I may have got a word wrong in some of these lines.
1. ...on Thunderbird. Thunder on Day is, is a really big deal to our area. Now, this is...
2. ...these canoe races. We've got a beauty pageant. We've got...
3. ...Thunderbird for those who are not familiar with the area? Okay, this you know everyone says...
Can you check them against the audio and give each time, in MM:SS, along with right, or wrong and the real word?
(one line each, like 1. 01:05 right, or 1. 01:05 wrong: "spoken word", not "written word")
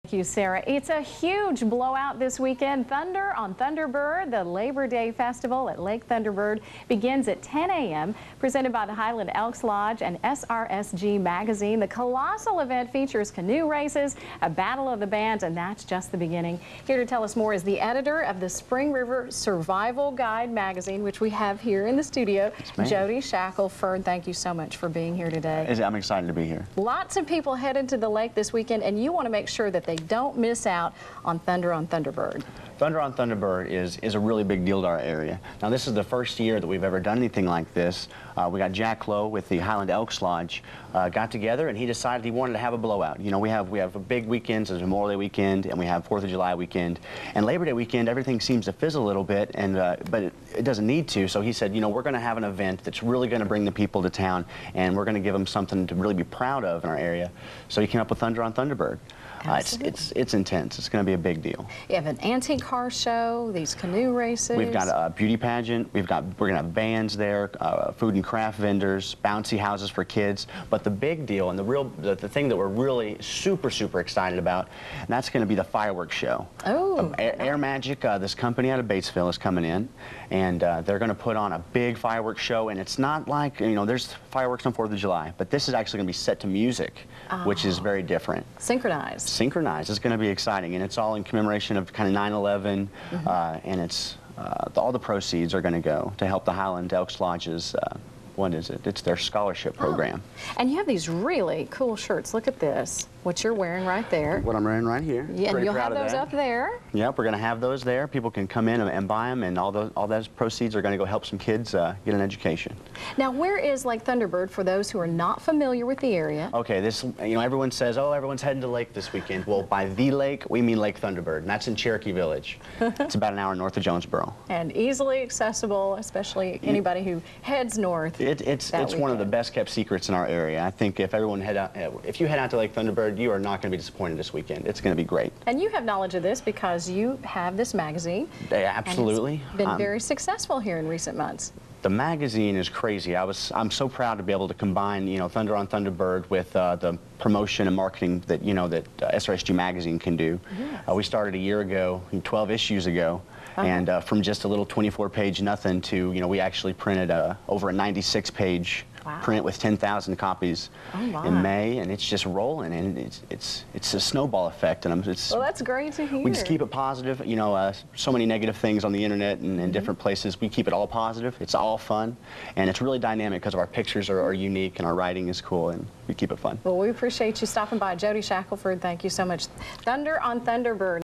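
1. 00:31 wrong: "Thunderbird", not "Day"
2. 01:03 right
3. 01:54 right.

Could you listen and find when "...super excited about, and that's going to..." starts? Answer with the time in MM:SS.
01:13.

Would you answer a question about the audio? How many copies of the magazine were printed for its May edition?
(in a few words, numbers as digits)
10,000.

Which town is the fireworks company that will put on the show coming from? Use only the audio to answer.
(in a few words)
Batesville.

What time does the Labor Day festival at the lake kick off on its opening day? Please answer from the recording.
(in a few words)
10 a.m.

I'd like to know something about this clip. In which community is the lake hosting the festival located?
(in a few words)
Cherokee Village.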